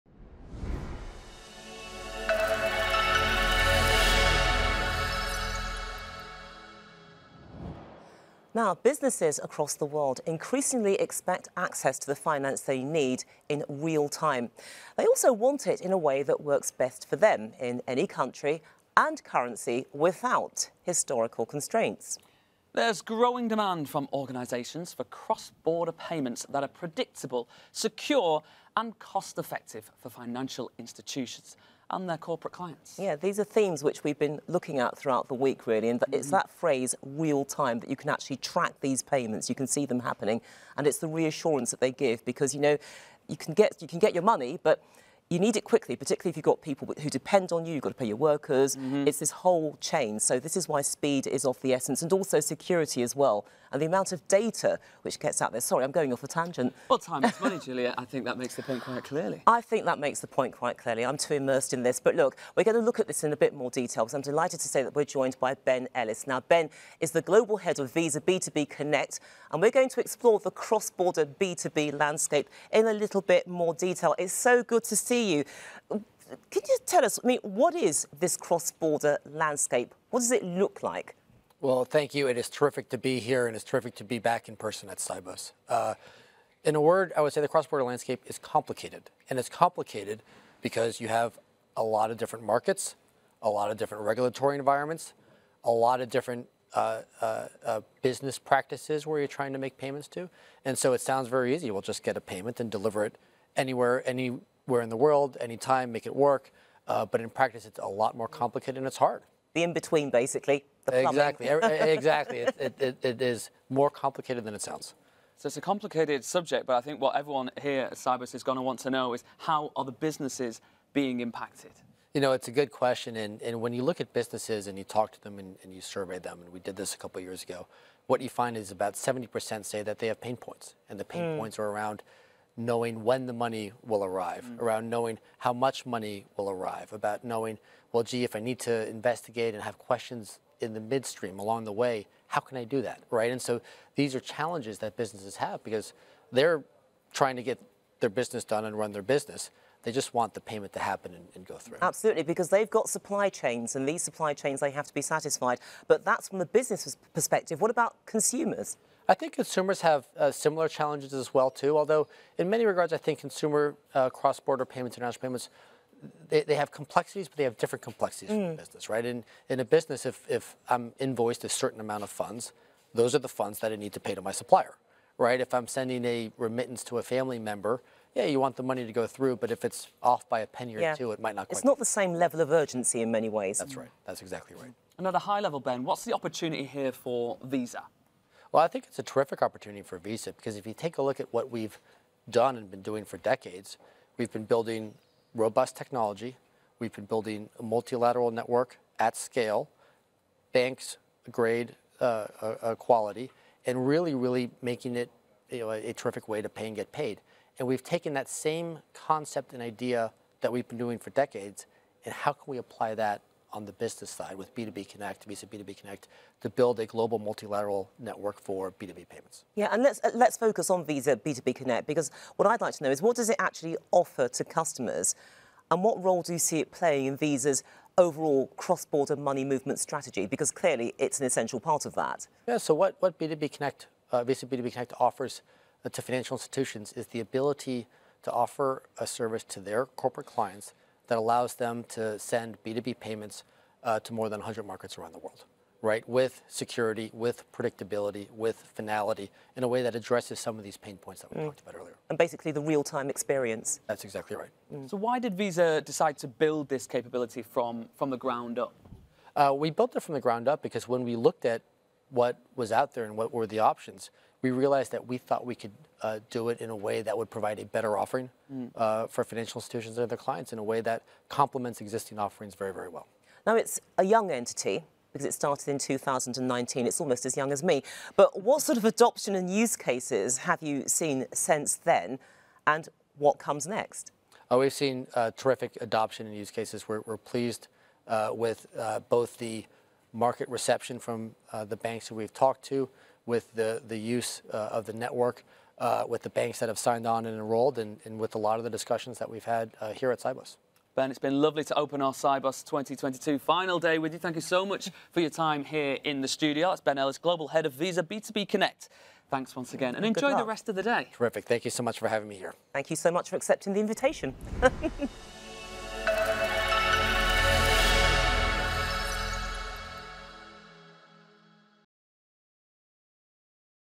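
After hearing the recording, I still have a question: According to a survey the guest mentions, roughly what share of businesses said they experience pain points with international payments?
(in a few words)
70%.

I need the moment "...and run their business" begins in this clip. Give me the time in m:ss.
2:28.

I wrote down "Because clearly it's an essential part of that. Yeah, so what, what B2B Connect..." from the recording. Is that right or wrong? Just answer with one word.
right.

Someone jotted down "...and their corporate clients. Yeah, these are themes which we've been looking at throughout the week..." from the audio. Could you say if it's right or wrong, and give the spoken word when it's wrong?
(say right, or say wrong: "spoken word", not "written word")
right.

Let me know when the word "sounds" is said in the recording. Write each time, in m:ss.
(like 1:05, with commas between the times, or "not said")
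1:41, 1:54.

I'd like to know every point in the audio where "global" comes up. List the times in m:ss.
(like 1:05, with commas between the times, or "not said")
1:07, 3:36, 5:07.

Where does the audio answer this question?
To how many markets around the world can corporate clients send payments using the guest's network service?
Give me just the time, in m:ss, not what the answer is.
4:04.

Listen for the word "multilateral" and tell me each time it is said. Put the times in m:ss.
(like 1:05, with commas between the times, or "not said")
3:17, 3:37.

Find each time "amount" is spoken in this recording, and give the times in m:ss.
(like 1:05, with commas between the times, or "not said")
0:53, 2:51.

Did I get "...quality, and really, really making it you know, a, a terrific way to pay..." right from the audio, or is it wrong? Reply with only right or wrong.
right.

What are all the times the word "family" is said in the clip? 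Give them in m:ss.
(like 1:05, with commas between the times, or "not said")
2:57.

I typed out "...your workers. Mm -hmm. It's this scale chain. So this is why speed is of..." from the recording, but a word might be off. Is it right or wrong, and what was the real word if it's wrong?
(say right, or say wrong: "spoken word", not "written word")
wrong: "whole", not "scale".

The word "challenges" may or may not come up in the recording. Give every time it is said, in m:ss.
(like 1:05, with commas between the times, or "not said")
2:24, 2:40.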